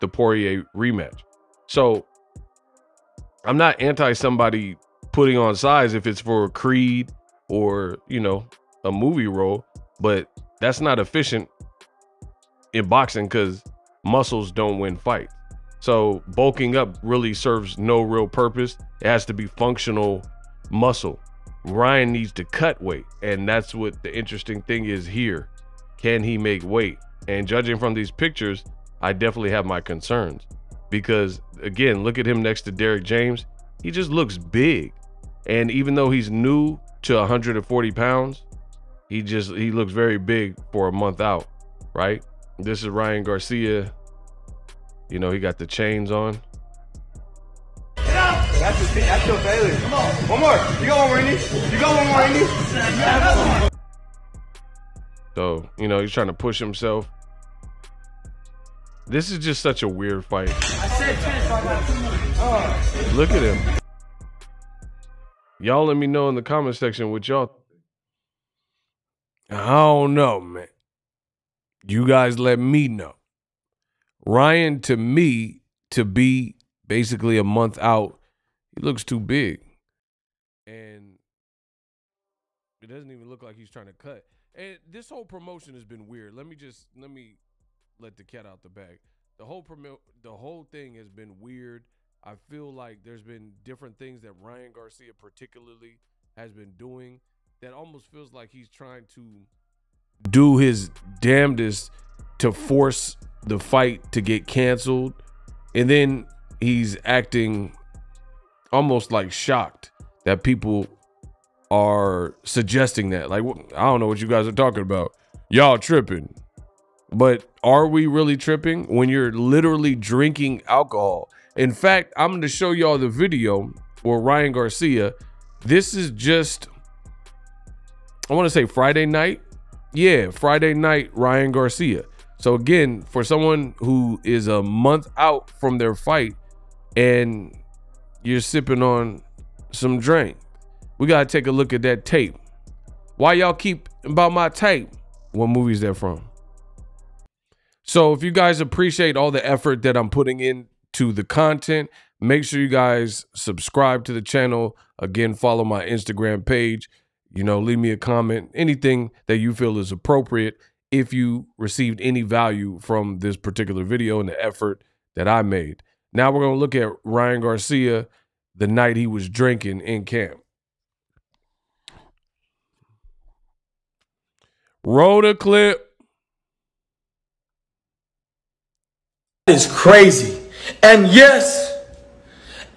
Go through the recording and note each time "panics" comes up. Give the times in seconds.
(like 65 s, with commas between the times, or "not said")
not said.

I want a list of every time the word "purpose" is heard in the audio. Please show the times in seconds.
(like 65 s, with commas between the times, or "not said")
18 s.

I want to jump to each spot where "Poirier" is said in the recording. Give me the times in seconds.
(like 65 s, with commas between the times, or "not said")
0 s.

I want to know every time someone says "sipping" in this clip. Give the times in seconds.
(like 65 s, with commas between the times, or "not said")
138 s.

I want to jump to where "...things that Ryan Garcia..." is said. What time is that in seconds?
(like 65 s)
93 s.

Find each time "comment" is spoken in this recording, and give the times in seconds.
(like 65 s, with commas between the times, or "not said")
66 s, 157 s.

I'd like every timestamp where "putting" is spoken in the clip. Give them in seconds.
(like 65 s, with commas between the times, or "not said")
5 s, 150 s.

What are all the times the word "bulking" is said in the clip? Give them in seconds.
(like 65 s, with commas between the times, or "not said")
16 s.